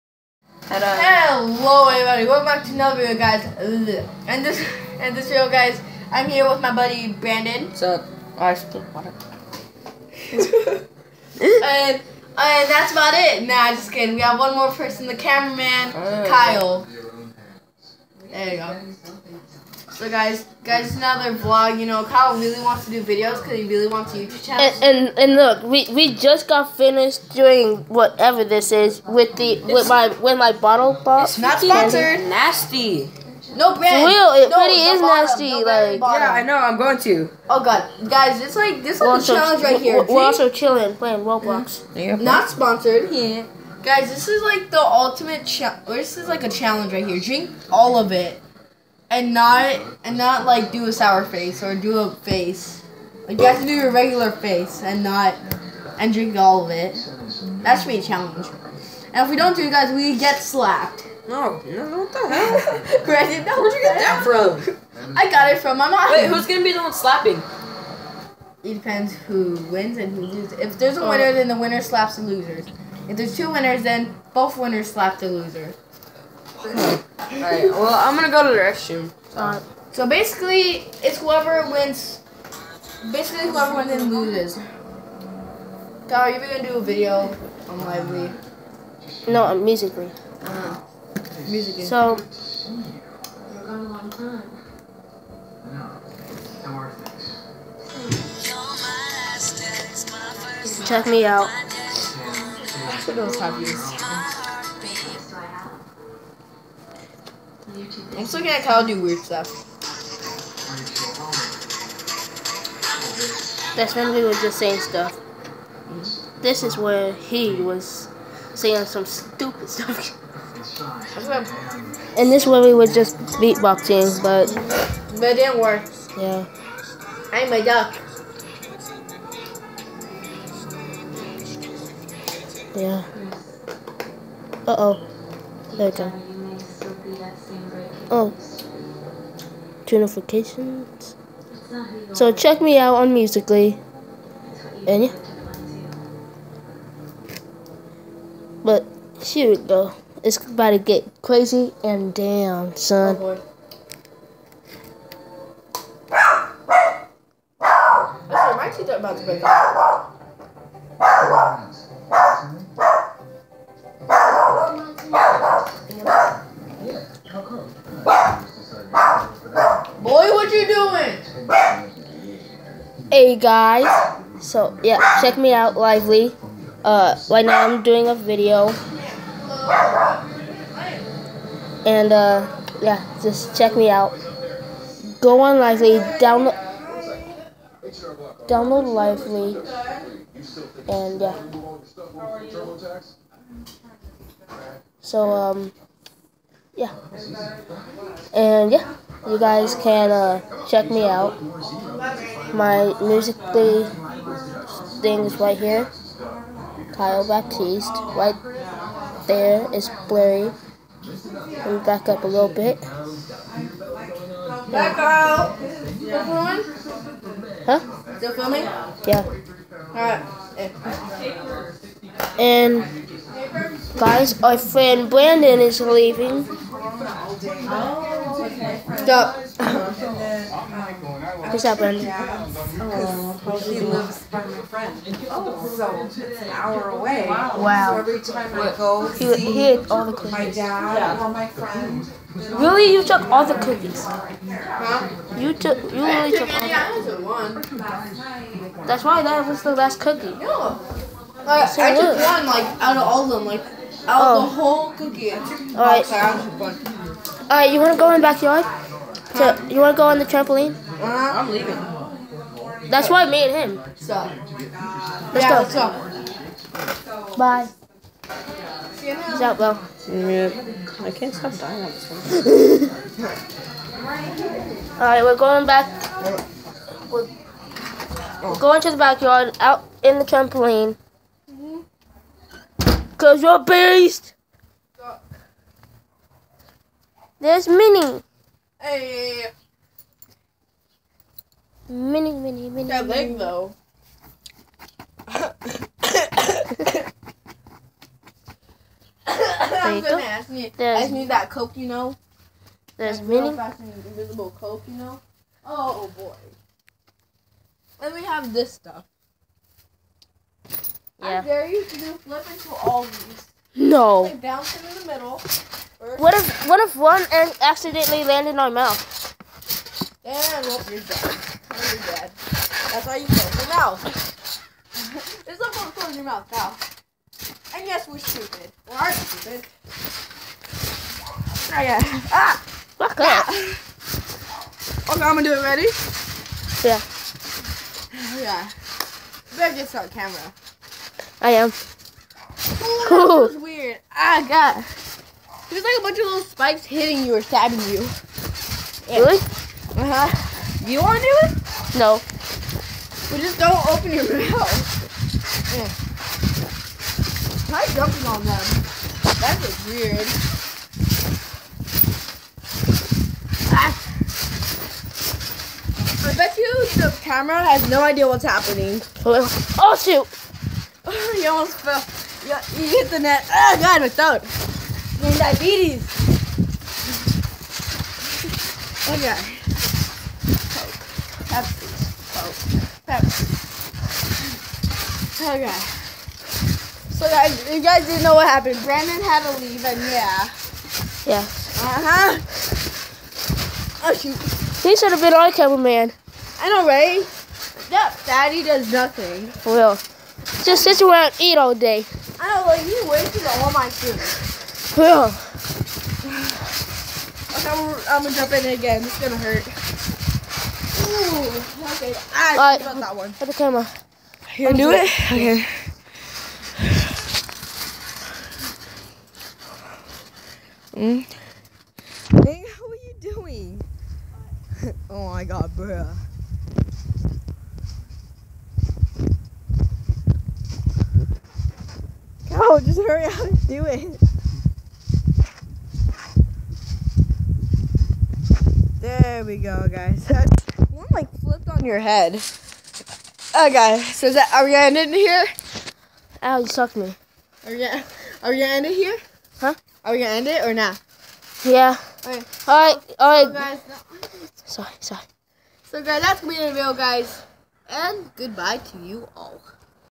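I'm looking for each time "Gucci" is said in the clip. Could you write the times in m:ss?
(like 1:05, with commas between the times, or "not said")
not said.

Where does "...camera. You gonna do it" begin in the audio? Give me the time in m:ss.
6:53.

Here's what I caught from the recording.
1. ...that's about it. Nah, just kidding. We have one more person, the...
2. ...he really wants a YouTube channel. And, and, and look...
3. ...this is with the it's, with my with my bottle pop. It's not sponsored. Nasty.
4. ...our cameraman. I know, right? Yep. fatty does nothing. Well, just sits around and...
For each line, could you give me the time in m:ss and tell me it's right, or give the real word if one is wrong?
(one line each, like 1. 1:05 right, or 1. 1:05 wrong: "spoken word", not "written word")
1. 0:12 right
2. 0:23 right
3. 0:28 right
4. 6:35 right.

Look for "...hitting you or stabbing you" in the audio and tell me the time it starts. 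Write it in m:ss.
5:46.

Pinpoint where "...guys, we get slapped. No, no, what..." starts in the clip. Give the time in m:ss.
0:59.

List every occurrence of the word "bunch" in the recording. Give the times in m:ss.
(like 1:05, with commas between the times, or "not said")
5:46.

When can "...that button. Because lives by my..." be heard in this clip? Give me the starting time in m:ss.
3:51.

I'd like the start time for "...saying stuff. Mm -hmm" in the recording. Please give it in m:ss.
1:54.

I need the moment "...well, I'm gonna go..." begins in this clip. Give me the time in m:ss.
1:17.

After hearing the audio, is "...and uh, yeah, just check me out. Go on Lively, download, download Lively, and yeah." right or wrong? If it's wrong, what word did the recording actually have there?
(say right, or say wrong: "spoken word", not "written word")
right.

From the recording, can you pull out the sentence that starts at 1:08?
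It depends who wins and who loses.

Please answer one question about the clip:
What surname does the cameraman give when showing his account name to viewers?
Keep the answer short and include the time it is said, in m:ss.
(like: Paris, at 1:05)
Baptiste, at 3:27.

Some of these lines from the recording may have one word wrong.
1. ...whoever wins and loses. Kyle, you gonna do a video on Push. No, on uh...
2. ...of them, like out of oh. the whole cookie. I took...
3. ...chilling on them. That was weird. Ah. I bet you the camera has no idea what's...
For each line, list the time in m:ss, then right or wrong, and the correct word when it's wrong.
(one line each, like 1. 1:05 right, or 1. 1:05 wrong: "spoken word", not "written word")
1. 1:23 wrong: "Lively", not "Push"
2. 4:13 right
3. 5:57 wrong: "jumping", not "chilling".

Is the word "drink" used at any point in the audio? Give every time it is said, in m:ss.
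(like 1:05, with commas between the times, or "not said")
0:47, 0:56.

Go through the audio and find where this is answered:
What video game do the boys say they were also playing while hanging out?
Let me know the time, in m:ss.
0:41.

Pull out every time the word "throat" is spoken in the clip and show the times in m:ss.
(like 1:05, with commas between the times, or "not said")
6:14.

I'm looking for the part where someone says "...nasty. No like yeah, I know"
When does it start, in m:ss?
0:35.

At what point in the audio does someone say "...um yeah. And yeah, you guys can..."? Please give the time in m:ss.
3:15.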